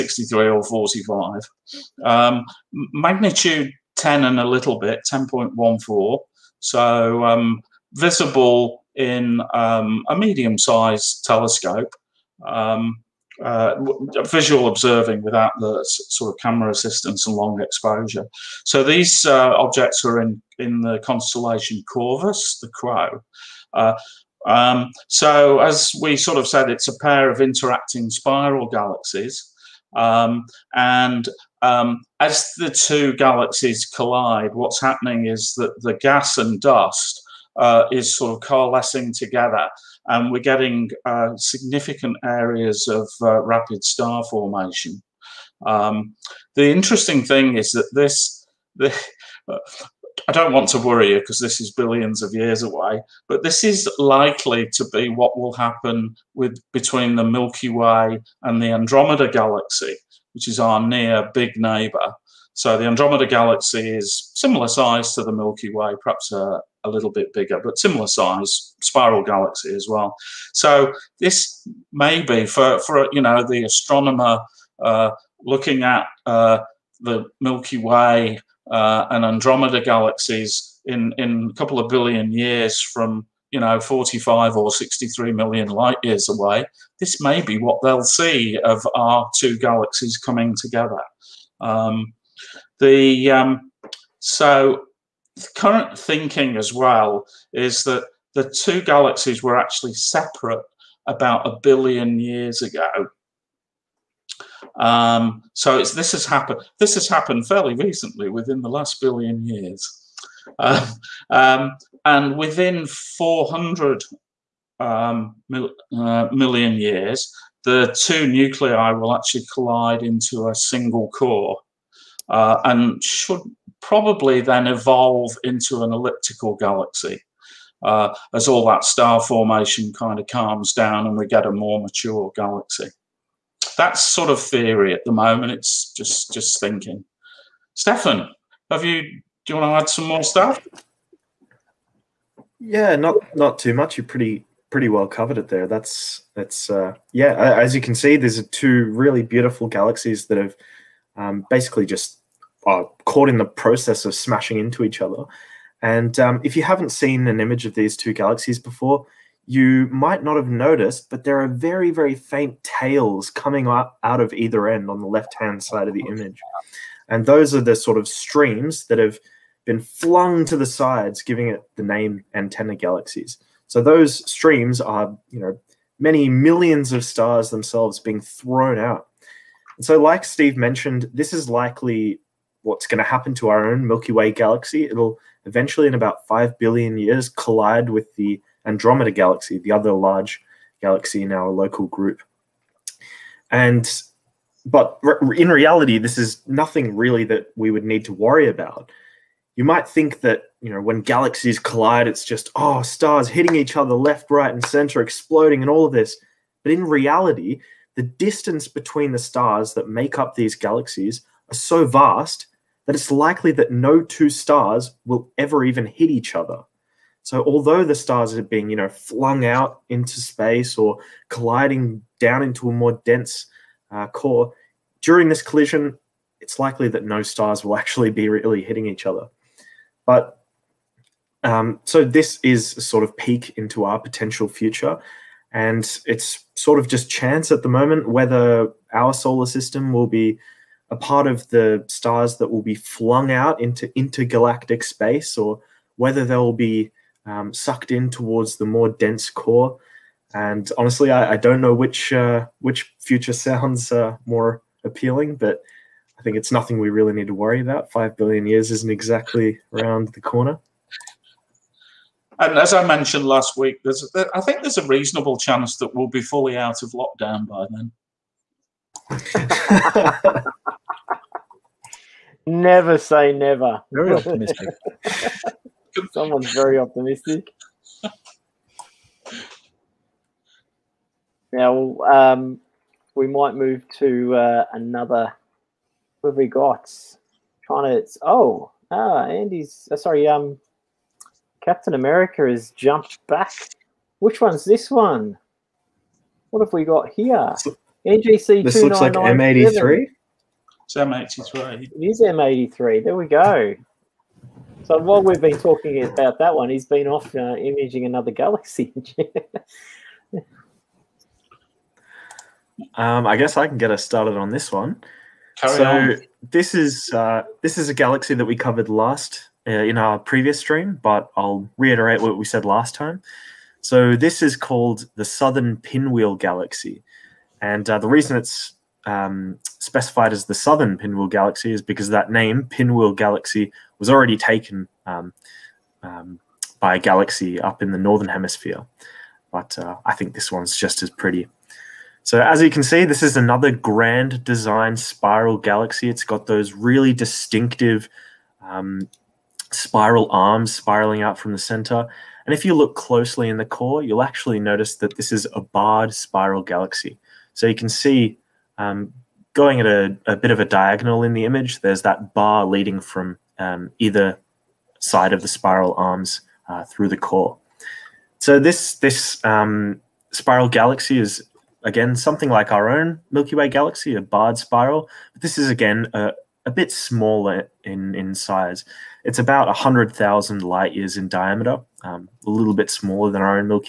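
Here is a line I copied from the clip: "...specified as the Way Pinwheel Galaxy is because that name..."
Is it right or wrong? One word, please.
wrong.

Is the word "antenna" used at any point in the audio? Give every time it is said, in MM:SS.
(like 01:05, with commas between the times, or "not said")
02:52.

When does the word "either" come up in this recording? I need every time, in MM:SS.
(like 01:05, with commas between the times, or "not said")
02:44, 06:03.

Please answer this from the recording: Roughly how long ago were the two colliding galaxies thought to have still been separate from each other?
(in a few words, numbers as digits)
a billion years ago.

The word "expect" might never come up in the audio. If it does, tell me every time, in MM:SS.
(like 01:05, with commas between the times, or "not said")
not said.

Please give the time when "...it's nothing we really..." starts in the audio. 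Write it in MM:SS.
04:16.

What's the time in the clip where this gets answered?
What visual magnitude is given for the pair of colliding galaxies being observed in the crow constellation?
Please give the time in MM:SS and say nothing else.
00:05.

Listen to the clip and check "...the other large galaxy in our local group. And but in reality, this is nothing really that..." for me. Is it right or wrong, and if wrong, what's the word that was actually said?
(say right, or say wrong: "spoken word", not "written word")
right.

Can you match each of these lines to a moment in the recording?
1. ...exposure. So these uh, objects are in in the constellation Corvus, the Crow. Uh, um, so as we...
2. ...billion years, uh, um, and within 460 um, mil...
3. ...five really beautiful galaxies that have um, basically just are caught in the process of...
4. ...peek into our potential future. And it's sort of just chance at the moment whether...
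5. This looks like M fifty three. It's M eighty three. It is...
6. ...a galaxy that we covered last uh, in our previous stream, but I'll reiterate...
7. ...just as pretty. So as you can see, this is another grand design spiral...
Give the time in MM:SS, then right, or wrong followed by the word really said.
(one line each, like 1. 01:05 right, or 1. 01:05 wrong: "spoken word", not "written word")
1. 00:17 right
2. 01:49 wrong: "400", not "460"
3. 02:28 wrong: "two", not "five"
4. 03:53 right
5. 04:58 wrong: "eighty", not "fifty"
6. 05:17 right
7. 05:40 right.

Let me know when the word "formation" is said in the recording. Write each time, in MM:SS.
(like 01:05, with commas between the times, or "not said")
00:44, 02:09.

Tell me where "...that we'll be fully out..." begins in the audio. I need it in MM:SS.
04:25.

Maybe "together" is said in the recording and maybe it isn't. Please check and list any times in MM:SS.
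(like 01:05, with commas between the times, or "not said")
00:39, 01:30.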